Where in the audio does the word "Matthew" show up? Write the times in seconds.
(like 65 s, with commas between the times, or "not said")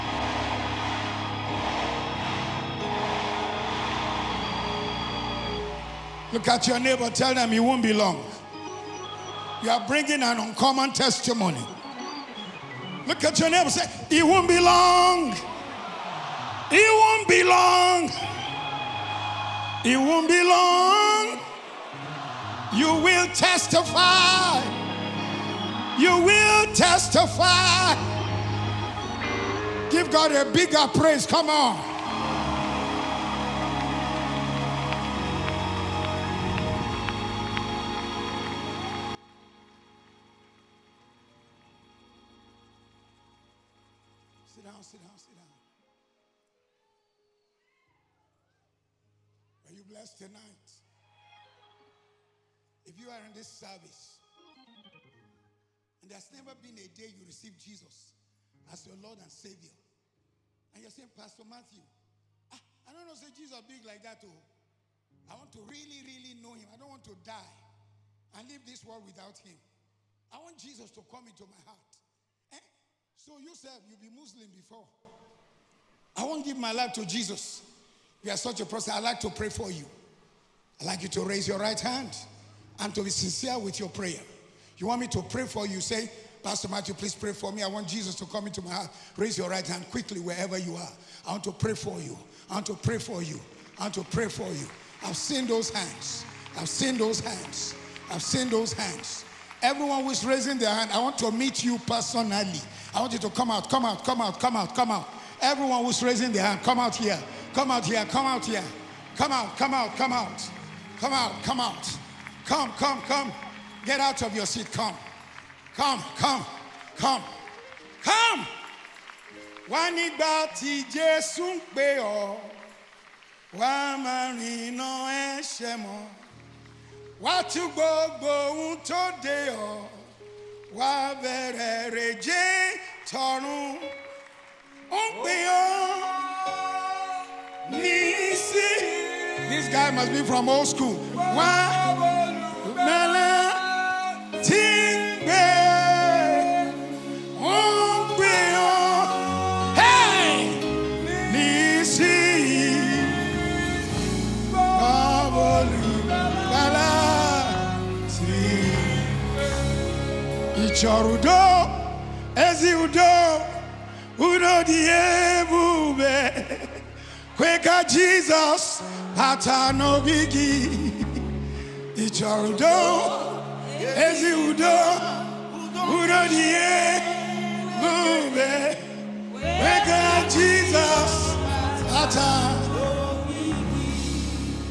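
61 s, 86 s.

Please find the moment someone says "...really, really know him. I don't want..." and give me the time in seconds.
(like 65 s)
65 s.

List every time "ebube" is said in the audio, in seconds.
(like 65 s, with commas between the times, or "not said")
164 s.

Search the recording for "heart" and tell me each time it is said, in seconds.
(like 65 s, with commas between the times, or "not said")
71 s, 88 s.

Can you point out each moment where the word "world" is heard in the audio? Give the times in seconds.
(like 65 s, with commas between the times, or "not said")
68 s.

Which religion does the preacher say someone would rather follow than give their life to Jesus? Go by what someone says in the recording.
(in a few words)
Muslim.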